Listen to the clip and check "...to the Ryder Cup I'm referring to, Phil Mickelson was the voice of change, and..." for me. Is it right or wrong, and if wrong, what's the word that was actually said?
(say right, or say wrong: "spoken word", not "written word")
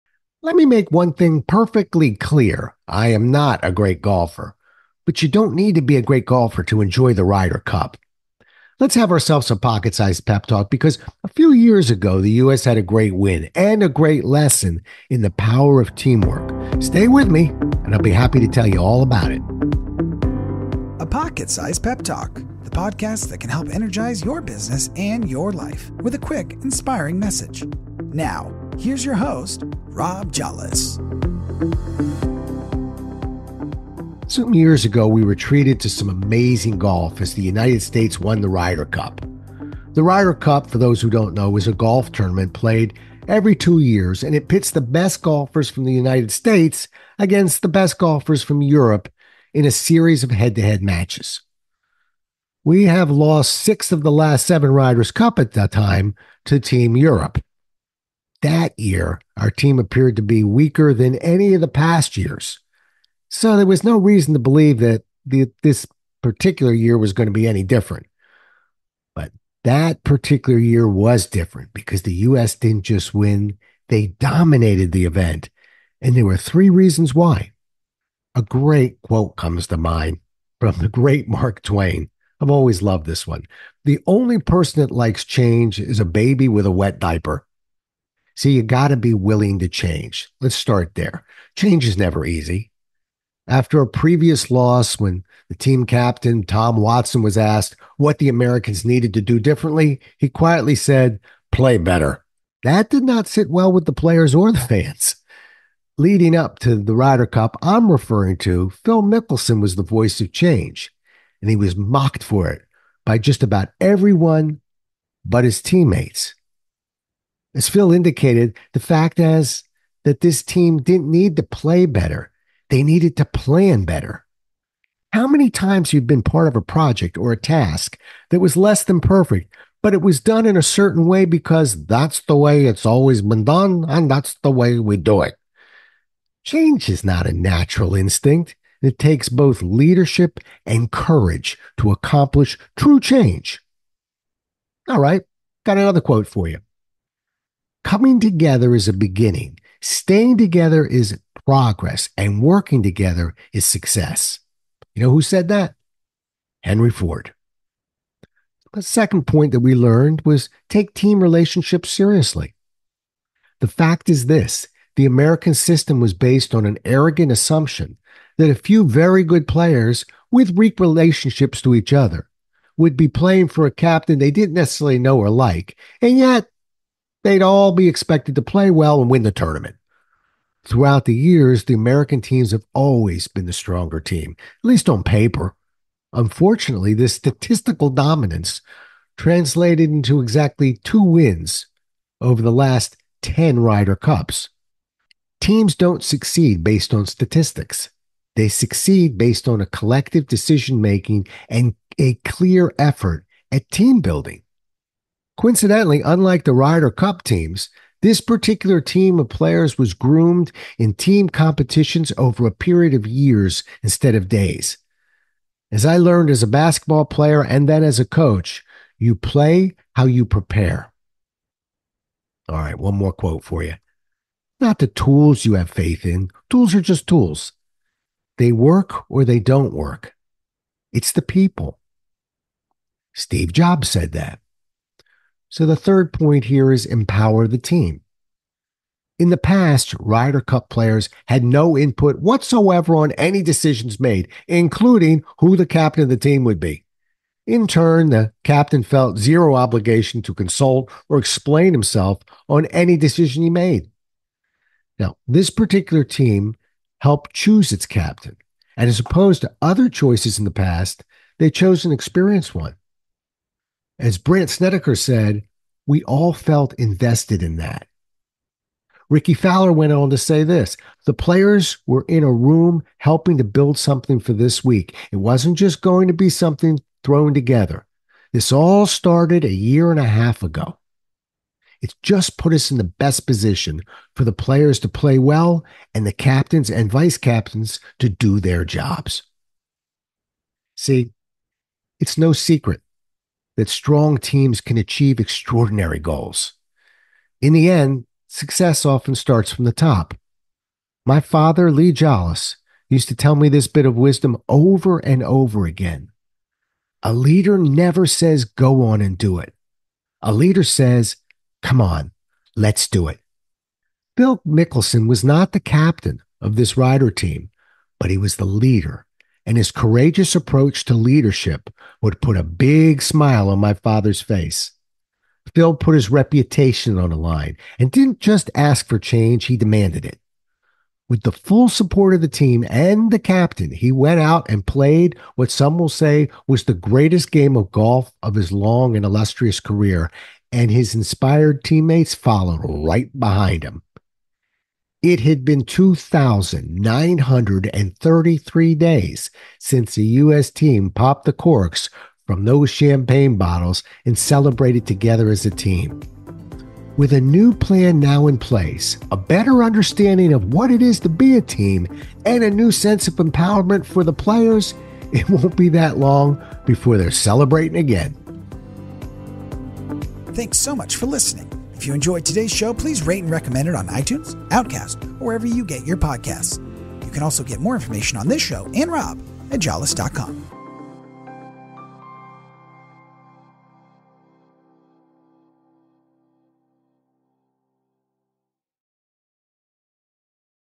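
right.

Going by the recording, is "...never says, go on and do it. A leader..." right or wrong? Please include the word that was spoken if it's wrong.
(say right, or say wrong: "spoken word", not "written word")
right.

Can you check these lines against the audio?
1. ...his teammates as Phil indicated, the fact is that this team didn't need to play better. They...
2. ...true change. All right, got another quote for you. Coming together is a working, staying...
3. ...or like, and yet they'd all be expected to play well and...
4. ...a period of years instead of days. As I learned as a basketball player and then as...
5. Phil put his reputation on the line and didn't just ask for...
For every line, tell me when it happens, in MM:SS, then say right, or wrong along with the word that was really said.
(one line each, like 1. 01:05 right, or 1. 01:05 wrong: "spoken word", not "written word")
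1. 01:55 right
2. 02:22 wrong: "beginning", not "working"
3. 02:55 right
4. 03:32 right
5. 05:25 right.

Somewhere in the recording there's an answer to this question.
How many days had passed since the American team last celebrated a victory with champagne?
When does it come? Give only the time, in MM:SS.
05:45.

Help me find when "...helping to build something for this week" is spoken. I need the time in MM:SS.
04:32.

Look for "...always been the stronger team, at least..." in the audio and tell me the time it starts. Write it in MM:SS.
03:02.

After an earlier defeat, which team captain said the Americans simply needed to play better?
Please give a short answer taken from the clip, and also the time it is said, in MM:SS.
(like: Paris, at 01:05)
Tom Watson, at 01:36.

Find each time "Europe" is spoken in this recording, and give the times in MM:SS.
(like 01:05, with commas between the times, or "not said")
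00:48, 00:56.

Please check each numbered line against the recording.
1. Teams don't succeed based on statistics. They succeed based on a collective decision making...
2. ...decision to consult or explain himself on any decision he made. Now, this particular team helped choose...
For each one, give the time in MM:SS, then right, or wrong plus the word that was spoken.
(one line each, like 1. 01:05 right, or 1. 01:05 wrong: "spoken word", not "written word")
1. 03:15 right
2. 04:09 wrong: "obligation", not "decision".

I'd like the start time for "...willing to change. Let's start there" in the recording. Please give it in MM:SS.
01:29.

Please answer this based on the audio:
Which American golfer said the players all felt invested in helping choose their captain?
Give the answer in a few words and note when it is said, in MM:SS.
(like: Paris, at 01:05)
Brandt Snedeker, at 04:24.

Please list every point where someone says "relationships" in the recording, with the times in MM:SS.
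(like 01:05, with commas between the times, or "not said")
02:41, 02:50.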